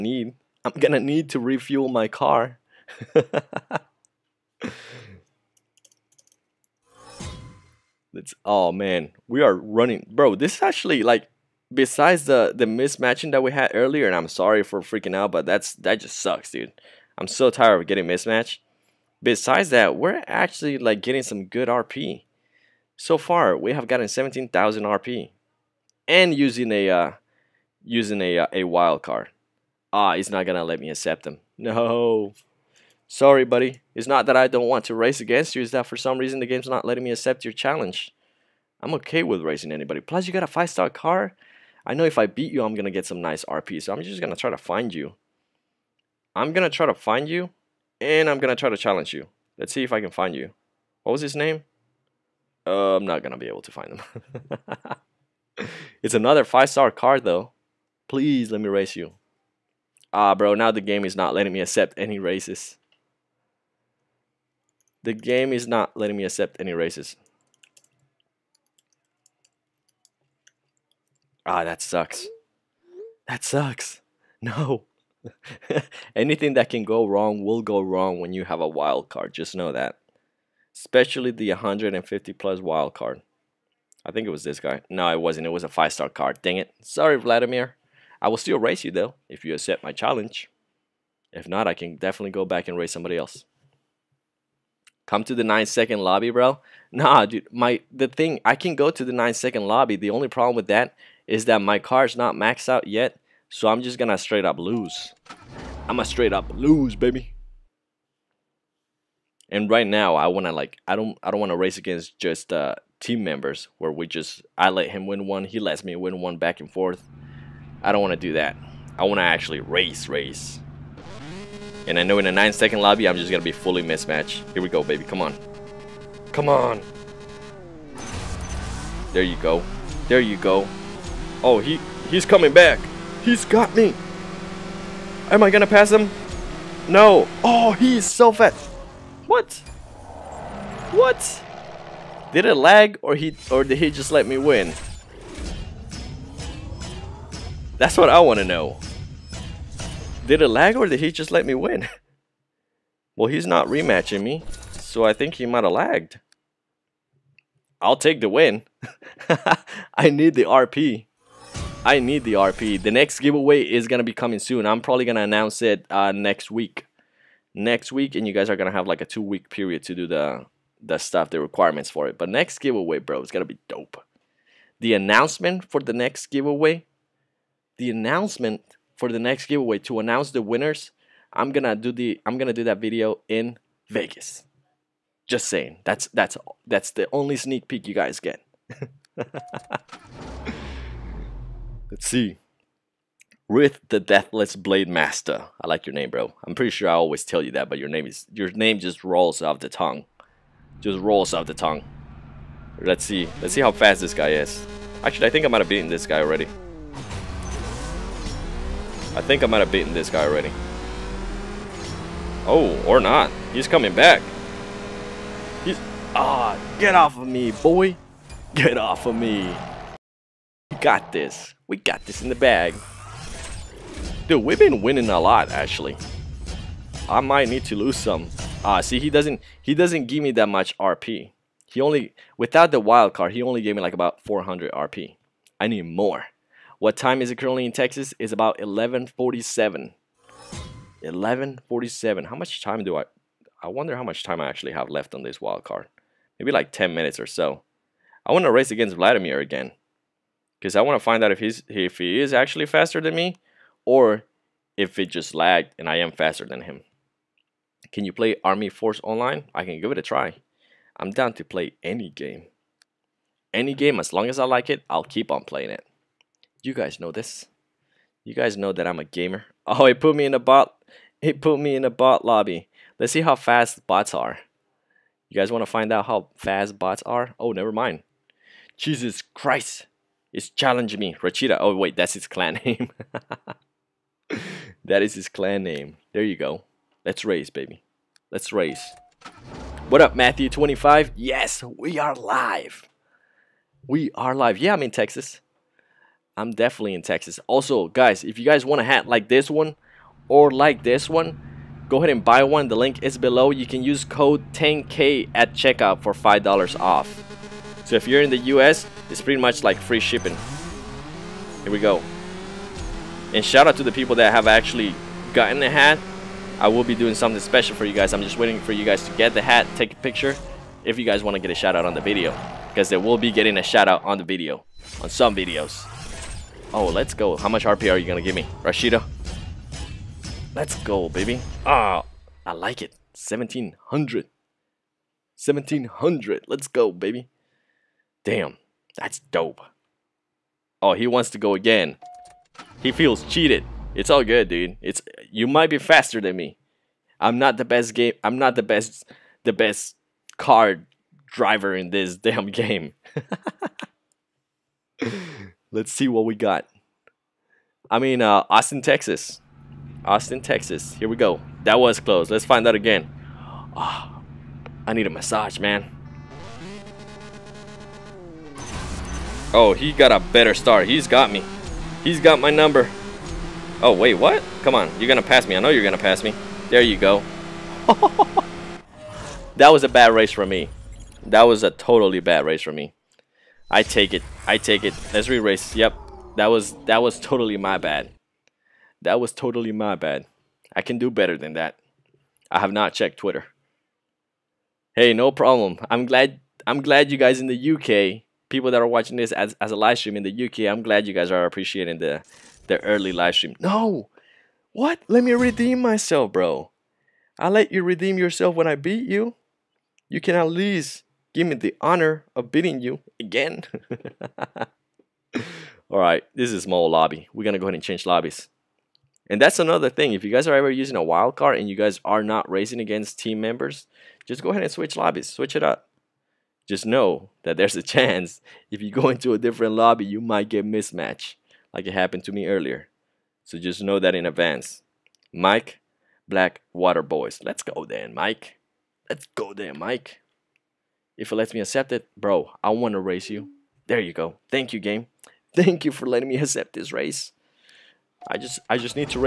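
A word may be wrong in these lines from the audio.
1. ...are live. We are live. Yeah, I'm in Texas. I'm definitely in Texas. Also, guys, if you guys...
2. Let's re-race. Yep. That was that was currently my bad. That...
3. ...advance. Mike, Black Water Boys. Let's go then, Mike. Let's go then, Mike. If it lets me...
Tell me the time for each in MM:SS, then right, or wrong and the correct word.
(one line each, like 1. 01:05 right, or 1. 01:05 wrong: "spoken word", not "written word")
1. 04:51 right
2. 06:25 wrong: "totally", not "currently"
3. 07:14 right.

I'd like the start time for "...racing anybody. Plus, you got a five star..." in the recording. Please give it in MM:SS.
00:39.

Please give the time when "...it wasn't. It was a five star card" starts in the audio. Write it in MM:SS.
01:25.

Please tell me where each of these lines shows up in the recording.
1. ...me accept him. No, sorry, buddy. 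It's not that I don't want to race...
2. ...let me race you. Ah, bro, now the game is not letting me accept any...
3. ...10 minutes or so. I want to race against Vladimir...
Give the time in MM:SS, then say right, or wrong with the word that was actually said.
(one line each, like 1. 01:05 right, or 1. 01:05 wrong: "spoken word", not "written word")
1. 00:30 right
2. 00:58 right
3. 04:06 right.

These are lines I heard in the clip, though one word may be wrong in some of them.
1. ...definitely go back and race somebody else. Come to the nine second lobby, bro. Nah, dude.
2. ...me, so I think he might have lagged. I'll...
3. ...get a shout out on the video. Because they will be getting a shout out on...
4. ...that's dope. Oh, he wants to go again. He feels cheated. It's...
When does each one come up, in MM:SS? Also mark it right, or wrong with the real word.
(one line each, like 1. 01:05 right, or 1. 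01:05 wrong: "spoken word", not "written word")
1. 01:31 right
2. 02:34 right
3. 05:21 right
4. 05:38 right.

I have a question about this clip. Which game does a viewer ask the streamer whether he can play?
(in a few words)
Army Force Online.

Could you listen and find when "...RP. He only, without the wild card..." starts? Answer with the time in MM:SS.
03:50.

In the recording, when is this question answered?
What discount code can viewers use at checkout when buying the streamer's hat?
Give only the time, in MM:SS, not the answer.
05:04.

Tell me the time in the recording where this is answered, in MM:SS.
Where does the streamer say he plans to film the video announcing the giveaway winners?
03:03.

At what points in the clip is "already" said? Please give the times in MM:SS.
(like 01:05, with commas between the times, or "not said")
03:26, 03:30.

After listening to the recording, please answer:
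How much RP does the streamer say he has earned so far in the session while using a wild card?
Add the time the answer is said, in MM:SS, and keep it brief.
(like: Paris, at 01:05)
17,000, at 00:24.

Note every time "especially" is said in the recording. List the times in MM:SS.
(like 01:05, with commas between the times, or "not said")
01:20.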